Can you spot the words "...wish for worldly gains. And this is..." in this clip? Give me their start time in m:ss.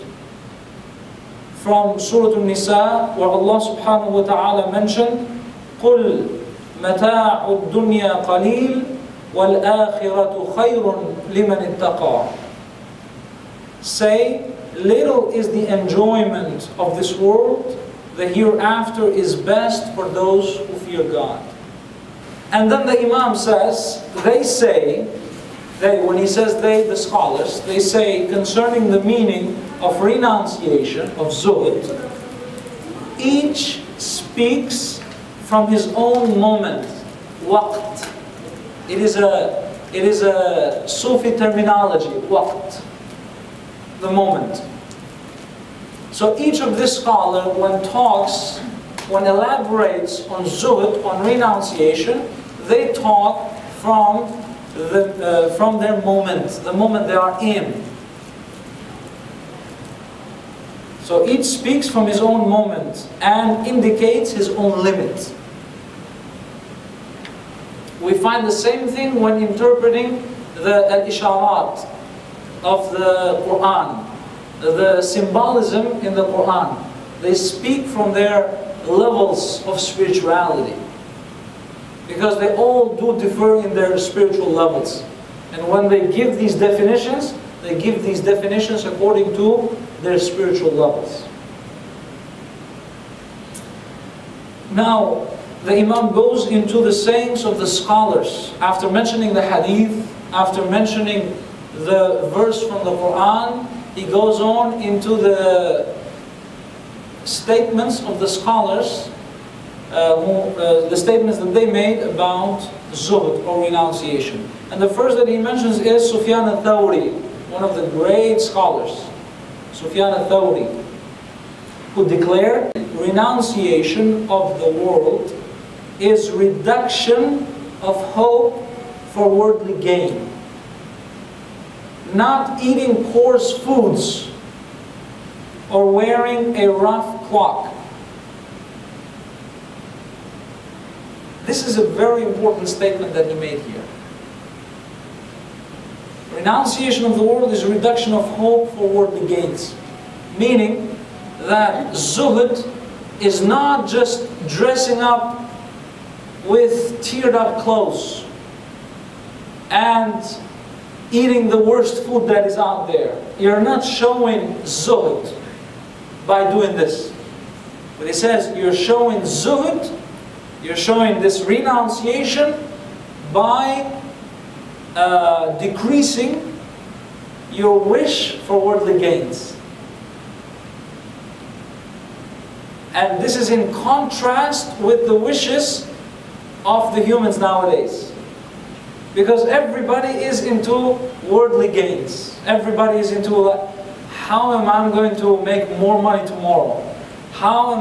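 2:57.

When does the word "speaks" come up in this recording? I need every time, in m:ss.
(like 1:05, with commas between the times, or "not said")
0:33, 1:01, 1:17.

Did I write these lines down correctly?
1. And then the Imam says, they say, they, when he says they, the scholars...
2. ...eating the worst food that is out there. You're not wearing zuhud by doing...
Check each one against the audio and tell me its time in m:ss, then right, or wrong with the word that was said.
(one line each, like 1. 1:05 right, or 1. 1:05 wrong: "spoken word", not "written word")
1. 0:22 right
2. 2:41 wrong: "showing", not "wearing".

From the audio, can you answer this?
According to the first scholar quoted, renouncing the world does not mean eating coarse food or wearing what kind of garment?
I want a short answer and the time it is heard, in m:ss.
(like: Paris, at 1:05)
a rough cloak, at 2:16.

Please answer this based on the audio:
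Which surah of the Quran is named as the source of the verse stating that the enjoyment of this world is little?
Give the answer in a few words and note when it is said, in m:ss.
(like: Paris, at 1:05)
Al-Nisa, at 0:01.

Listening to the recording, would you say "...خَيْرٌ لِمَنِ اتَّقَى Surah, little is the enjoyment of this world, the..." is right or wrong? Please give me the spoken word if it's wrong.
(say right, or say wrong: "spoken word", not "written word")
wrong: "Say", not "Surah".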